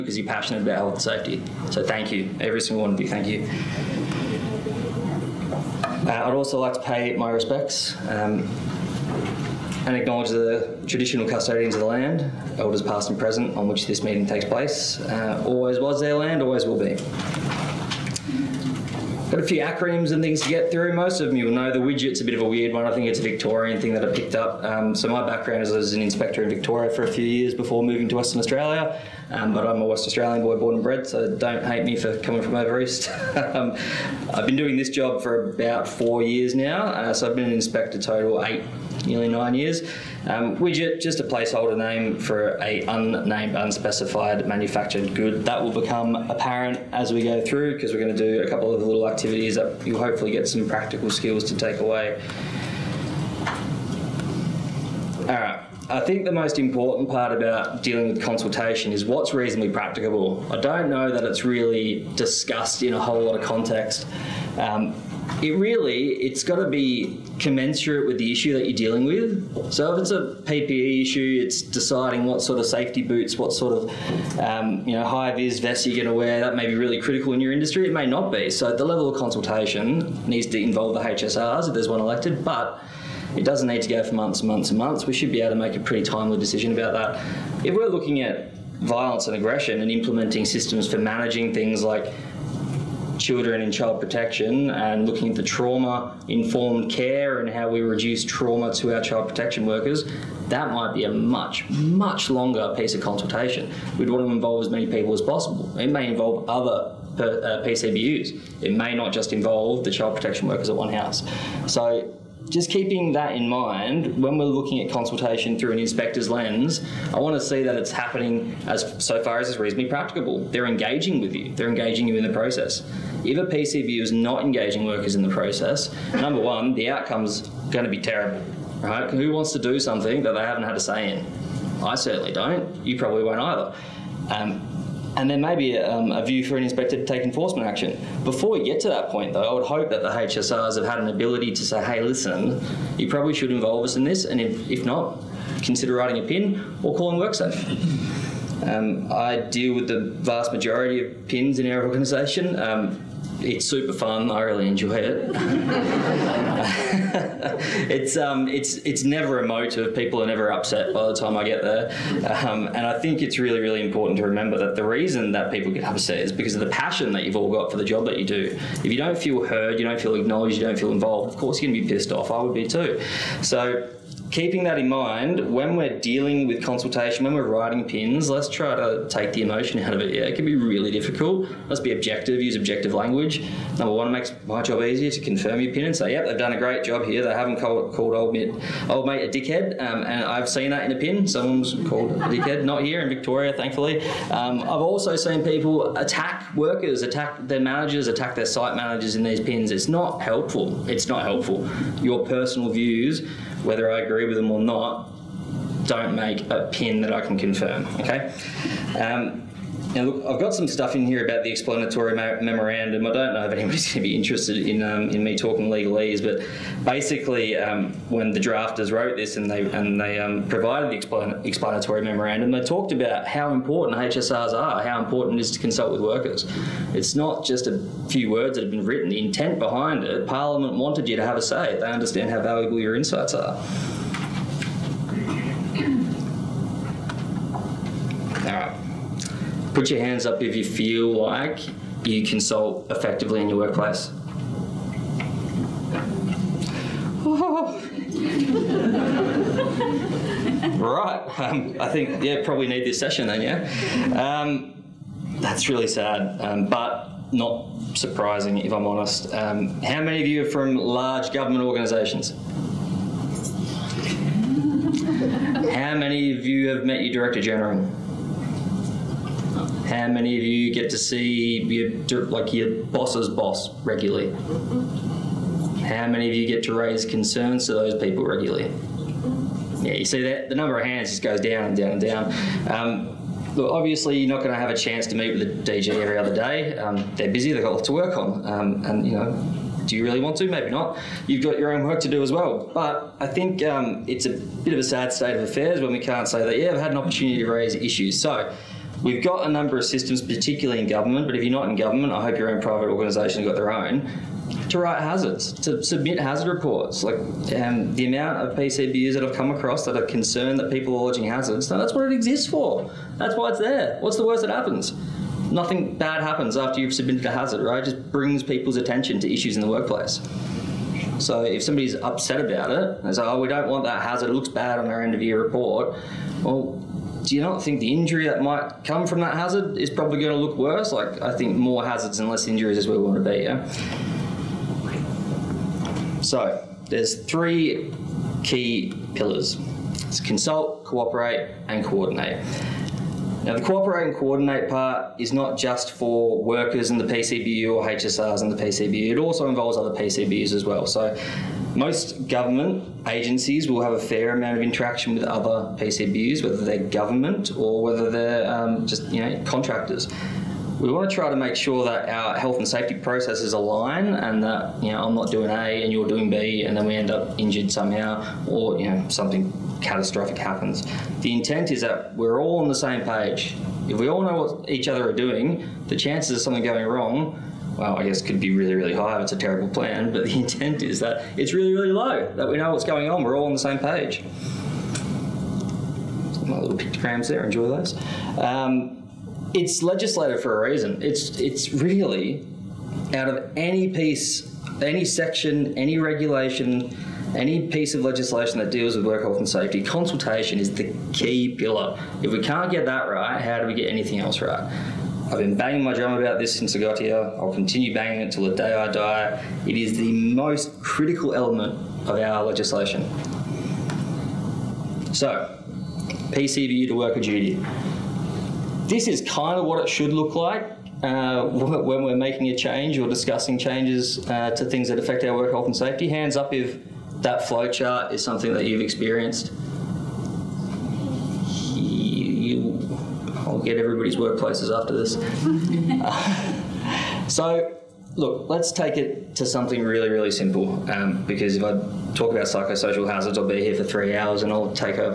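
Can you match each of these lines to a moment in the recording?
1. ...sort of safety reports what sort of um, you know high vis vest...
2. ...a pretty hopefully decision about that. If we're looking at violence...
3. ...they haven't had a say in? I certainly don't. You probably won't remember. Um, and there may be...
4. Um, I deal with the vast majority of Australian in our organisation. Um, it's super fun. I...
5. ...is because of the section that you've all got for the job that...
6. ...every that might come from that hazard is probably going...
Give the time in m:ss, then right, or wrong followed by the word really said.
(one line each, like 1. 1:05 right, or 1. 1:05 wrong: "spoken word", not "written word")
1. 1:12 wrong: "boots", not "reports"
2. 1:25 wrong: "timely", not "hopefully"
3. 2:10 wrong: "either", not "remember"
4. 2:28 wrong: "PINs", not "Australian"
5. 2:46 wrong: "passion", not "section"
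6. 5:27 wrong: "injury", not "every".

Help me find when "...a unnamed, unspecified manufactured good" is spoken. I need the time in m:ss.
0:42.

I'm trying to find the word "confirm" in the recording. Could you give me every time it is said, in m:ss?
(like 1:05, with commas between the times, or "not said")
3:05, 3:27.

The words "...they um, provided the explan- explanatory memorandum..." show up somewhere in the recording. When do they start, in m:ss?
3:40.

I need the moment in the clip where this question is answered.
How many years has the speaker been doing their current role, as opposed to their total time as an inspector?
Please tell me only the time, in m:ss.
0:35.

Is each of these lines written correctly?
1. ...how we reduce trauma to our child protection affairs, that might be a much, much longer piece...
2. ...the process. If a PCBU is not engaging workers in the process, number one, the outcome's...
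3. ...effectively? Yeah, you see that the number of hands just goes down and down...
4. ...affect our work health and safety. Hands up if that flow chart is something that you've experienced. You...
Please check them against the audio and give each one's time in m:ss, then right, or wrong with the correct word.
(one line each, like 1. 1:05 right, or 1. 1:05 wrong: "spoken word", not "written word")
1. 1:37 wrong: "workers", not "affairs"
2. 2:02 right
3. 4:38 wrong: "regularly", not "effectively"
4. 7:04 right.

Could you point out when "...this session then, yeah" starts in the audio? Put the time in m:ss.
4:12.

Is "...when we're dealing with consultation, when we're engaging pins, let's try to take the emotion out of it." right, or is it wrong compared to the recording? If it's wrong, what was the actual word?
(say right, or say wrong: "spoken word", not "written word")
wrong: "writing", not "engaging".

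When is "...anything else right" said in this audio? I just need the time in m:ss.
6:43.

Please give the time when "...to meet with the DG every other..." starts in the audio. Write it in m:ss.
4:45.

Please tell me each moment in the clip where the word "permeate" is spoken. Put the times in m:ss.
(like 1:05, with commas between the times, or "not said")
not said.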